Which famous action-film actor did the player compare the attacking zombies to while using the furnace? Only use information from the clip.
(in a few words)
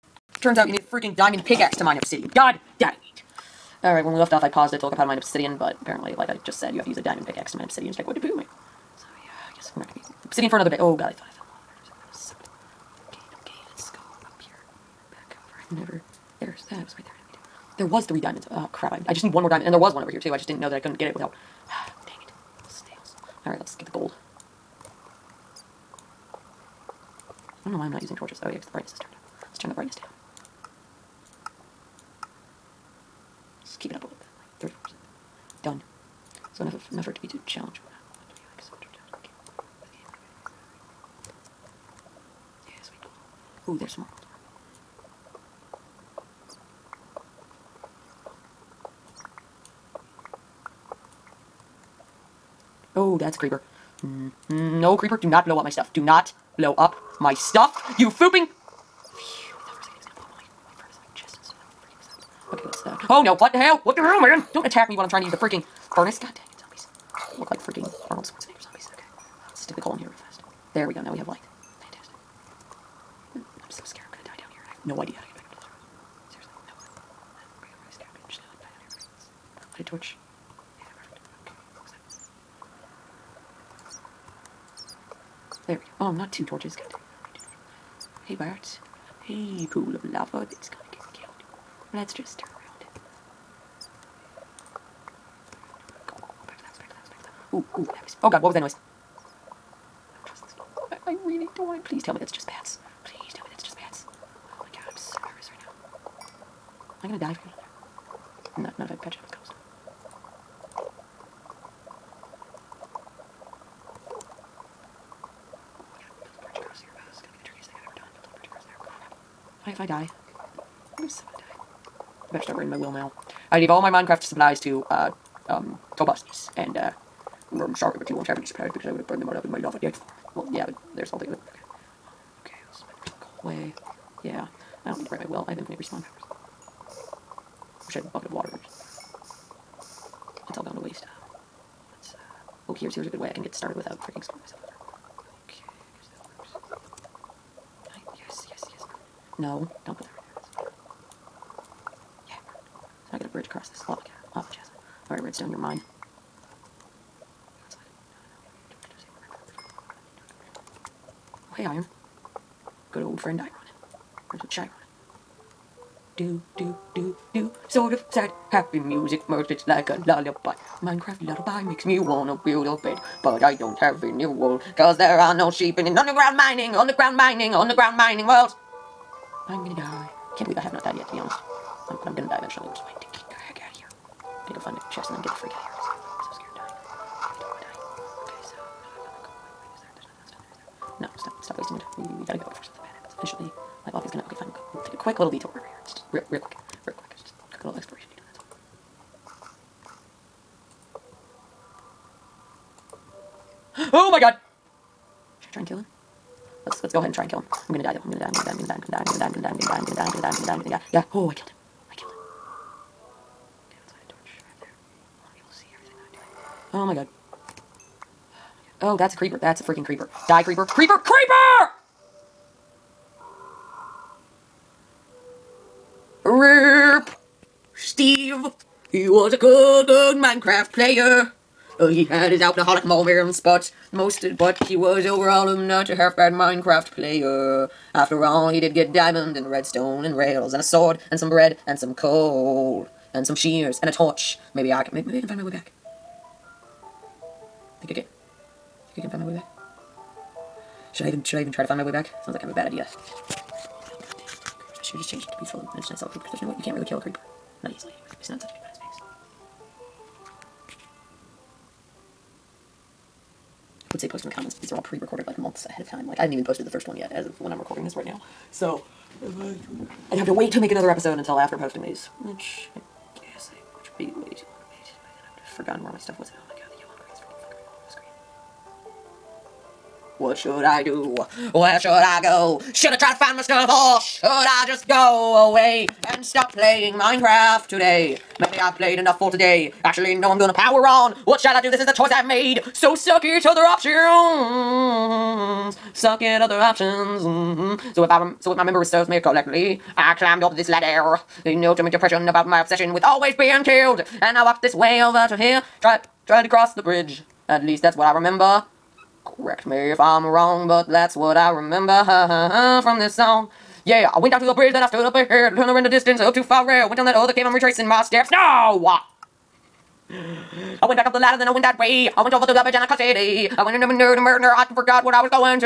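Arnold Schwarzenegger.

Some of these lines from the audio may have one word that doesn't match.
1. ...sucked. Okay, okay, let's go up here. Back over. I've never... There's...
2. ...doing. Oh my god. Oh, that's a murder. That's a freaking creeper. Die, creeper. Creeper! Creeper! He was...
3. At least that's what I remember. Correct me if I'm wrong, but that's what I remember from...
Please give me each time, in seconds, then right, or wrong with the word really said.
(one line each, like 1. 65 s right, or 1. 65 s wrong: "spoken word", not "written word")
1. 12 s right
2. 216 s wrong: "creeper", not "murder"
3. 307 s right.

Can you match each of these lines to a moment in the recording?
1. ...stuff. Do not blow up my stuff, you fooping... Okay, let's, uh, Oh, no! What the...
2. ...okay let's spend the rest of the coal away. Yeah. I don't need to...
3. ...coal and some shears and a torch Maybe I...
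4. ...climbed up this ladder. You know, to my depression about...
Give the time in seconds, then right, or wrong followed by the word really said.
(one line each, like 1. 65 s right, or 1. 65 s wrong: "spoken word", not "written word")
1. 55 s right
2. 132 s right
3. 241 s right
4. 300 s right.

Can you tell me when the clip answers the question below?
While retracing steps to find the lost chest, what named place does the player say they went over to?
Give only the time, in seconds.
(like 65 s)
322 s.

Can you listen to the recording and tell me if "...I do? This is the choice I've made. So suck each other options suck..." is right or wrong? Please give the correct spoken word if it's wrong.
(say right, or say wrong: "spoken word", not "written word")
right.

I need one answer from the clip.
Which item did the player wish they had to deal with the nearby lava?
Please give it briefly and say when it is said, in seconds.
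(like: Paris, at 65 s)
bucket of water, at 138 s.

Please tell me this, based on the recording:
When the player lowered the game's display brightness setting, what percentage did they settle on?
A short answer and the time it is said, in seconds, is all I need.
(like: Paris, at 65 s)
34%, at 34 s.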